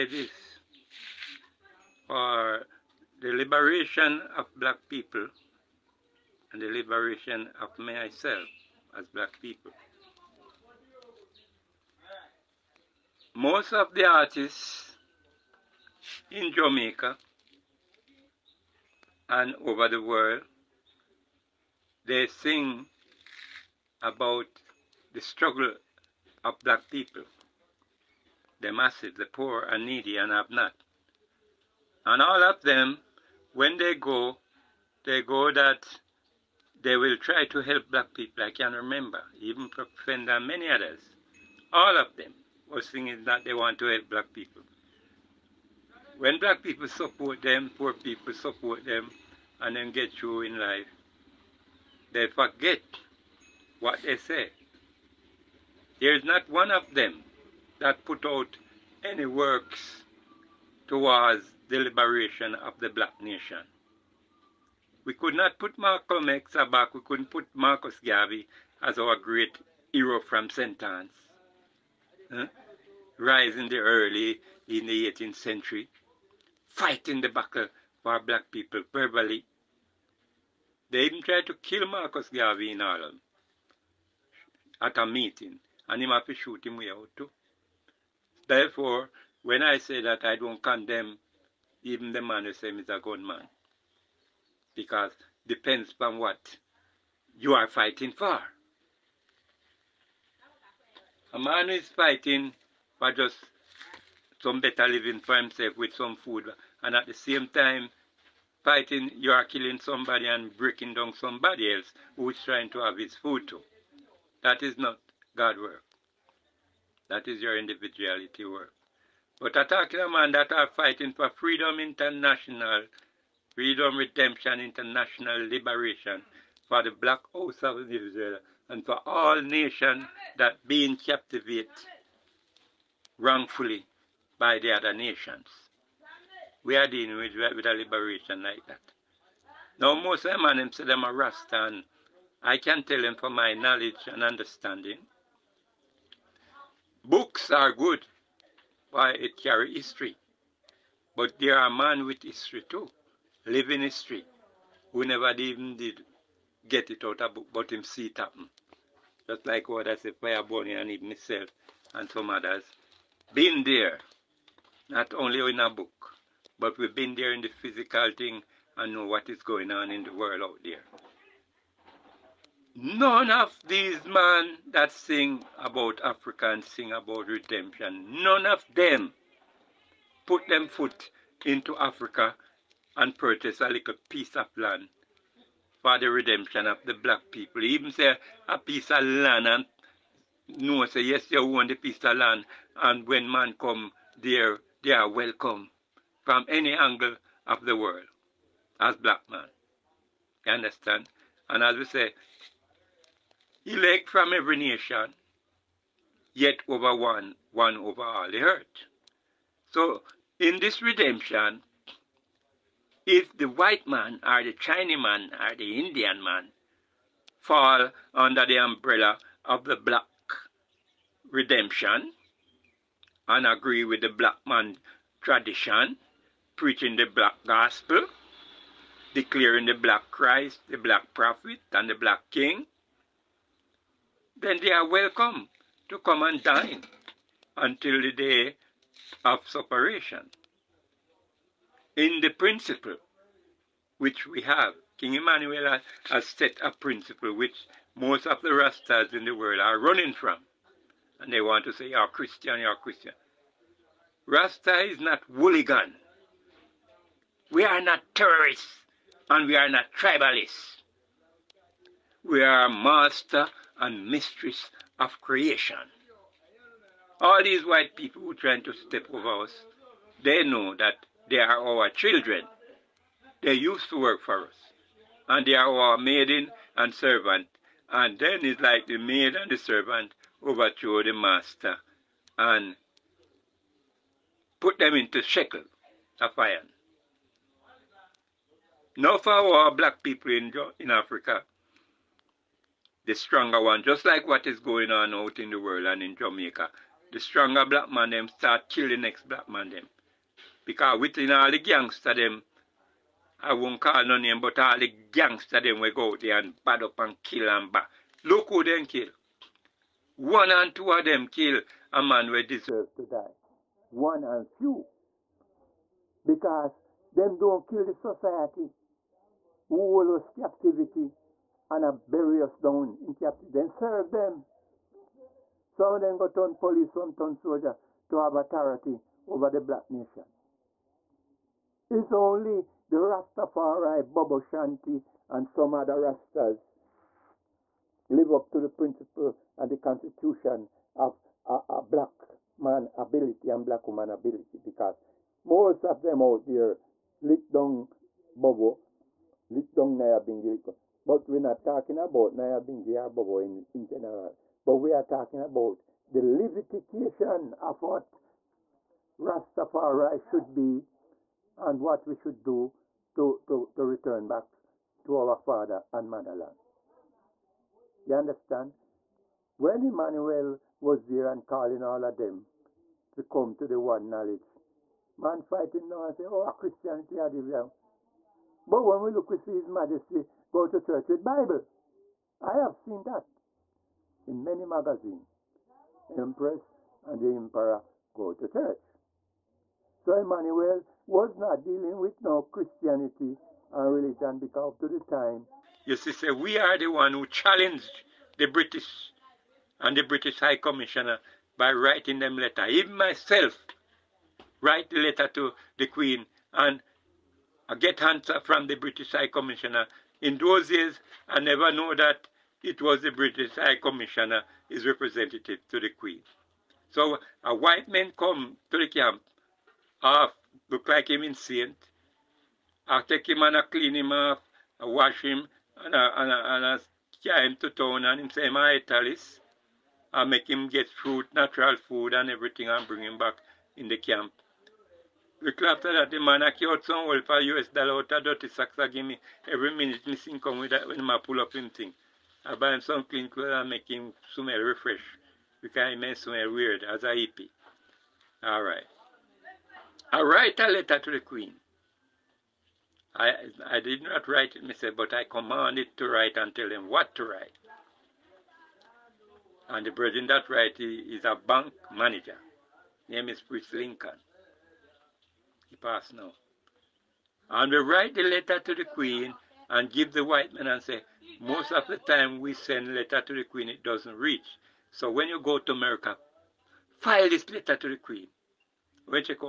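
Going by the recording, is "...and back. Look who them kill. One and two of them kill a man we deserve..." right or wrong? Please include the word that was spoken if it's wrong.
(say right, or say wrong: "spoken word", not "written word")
right.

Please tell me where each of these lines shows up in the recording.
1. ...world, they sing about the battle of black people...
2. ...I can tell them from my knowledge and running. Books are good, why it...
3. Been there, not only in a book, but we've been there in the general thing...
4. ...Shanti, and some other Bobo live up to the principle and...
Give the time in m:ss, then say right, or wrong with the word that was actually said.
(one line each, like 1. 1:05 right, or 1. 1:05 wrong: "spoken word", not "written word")
1. 0:20 wrong: "struggle", not "battle"
2. 2:22 wrong: "understanding", not "running"
3. 2:43 wrong: "physical", not "general"
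4. 5:34 wrong: "Rastas", not "Bobo".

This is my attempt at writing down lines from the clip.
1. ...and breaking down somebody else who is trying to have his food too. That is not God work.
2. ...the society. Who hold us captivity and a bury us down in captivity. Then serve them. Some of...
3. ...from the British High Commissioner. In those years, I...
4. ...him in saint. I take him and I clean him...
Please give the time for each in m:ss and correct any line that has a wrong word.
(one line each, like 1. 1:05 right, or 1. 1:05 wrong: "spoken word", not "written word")
1. 1:50 right
2. 5:17 right
3. 6:48 right
4. 7:01 right.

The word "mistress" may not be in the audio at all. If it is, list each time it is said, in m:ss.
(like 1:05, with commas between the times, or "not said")
4:24.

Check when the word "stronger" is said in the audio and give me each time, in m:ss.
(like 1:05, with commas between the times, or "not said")
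4:53, 4:57.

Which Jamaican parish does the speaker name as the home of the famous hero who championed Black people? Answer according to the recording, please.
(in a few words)
St. Ann.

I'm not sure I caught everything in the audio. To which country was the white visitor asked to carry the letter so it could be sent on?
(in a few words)
America.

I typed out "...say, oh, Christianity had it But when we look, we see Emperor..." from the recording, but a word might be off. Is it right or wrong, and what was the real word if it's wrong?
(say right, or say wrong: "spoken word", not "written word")
wrong: "His", not "Emperor".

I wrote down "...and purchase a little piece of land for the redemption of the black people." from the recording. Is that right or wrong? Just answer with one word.
right.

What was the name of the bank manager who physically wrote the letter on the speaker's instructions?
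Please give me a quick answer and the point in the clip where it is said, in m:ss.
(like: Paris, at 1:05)
Fritz Lincoln, at 7:43.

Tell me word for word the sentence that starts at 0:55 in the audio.
There is not one of them that put out any works towards the liberation of the black nation.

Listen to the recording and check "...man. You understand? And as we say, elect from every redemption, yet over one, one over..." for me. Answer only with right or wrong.
wrong.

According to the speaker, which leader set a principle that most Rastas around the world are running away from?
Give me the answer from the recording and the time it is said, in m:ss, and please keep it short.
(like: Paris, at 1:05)
King Emmanuel, at 4:04.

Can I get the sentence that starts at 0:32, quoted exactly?
And all of them, when they go, they go that they will try to help black people.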